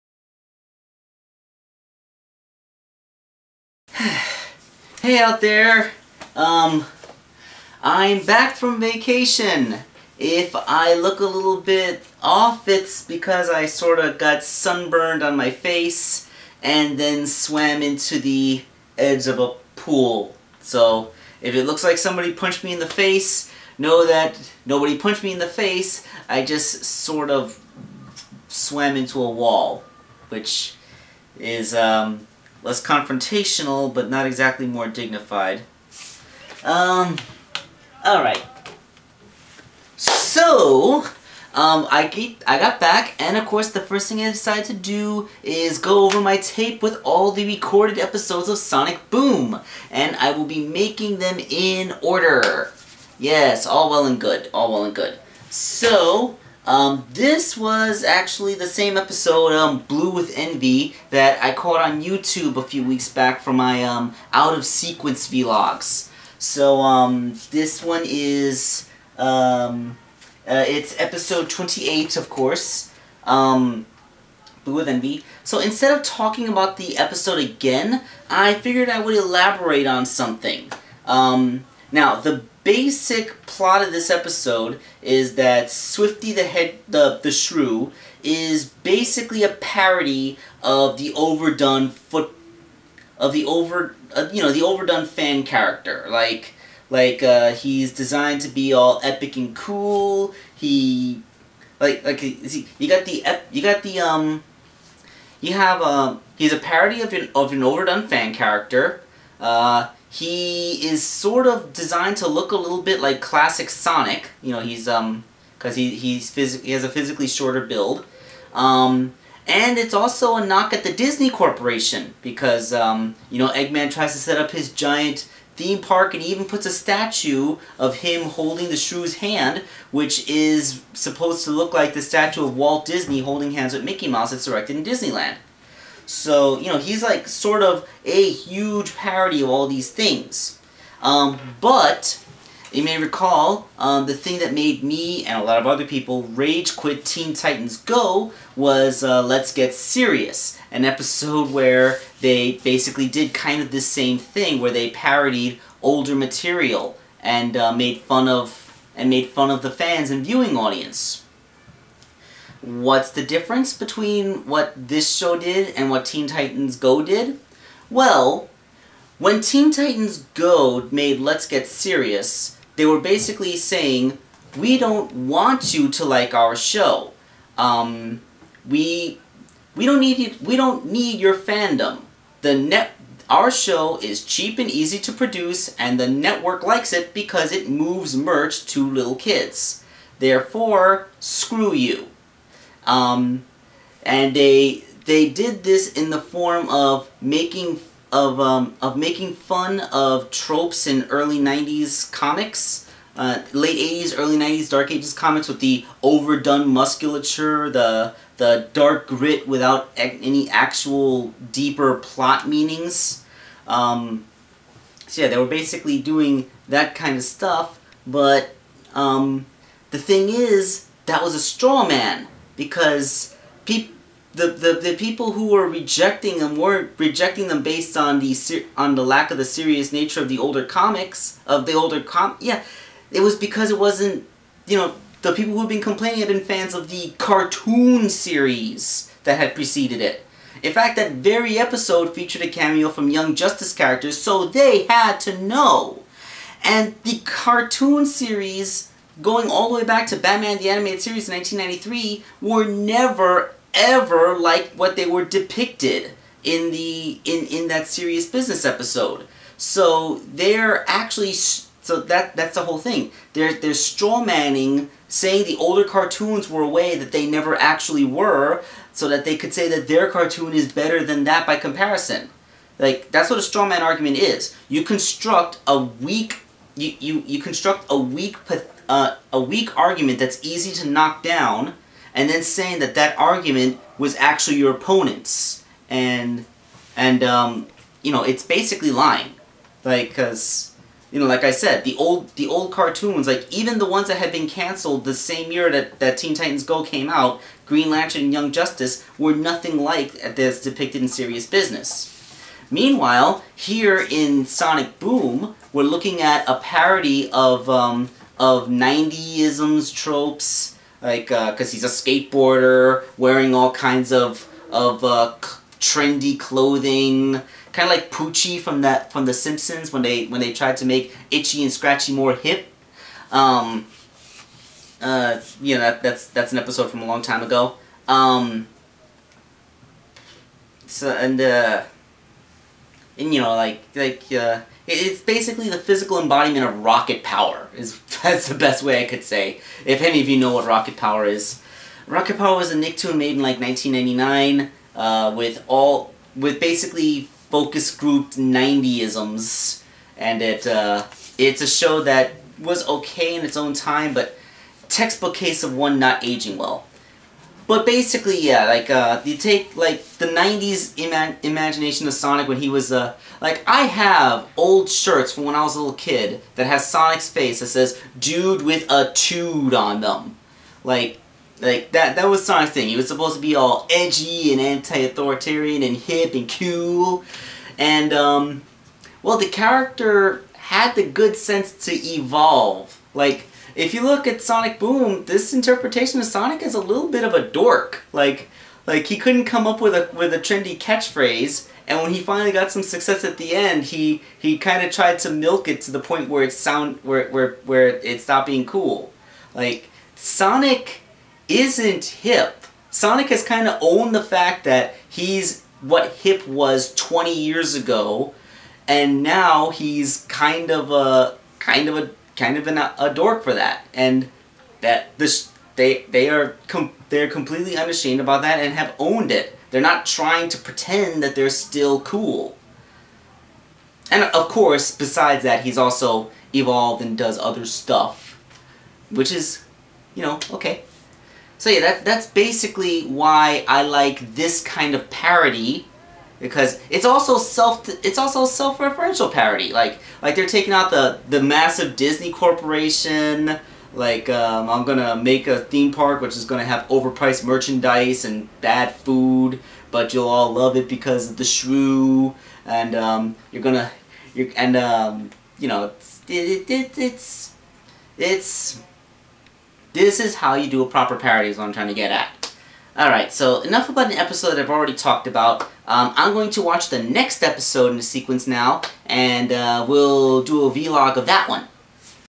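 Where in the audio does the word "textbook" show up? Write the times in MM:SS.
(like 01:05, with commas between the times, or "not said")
05:54.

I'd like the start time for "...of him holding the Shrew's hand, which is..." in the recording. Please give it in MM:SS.
02:07.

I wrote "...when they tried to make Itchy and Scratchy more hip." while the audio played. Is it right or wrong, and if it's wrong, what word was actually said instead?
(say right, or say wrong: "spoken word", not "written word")
right.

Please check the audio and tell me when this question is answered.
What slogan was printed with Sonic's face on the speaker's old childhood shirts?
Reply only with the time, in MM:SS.
06:08.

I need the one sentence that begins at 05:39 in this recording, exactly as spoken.
If any of you know what Rocket Power is.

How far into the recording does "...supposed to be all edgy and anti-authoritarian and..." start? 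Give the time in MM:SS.
06:13.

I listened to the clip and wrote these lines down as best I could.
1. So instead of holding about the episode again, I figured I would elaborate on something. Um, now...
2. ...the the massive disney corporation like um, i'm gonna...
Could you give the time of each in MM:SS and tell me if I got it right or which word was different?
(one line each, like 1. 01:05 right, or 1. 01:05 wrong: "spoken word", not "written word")
1. 01:15 wrong: "talking", not "holding"
2. 07:20 right.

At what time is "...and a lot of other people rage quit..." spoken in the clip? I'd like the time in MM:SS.
02:25.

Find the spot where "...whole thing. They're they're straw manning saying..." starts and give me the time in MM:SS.
04:22.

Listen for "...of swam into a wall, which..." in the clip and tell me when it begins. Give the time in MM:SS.
00:27.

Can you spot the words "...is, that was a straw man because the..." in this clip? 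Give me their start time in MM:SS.
03:40.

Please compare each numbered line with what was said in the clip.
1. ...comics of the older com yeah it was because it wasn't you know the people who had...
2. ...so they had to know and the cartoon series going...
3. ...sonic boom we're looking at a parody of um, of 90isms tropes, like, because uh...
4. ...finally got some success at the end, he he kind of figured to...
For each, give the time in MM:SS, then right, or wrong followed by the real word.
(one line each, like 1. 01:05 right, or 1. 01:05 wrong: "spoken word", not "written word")
1. 03:50 right
2. 04:04 right
3. 05:04 right
4. 06:32 wrong: "tried", not "figured".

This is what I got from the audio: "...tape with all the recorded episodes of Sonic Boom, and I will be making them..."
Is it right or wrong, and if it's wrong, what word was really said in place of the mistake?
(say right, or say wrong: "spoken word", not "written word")
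right.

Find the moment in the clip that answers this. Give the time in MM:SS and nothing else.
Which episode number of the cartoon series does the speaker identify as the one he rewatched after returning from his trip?
01:11.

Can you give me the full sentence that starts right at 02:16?
So, you know, he's like sort of a huge parody of all these things.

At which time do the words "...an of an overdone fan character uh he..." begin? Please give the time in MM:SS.
01:47.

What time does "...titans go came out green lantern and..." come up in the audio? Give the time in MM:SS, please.
04:56.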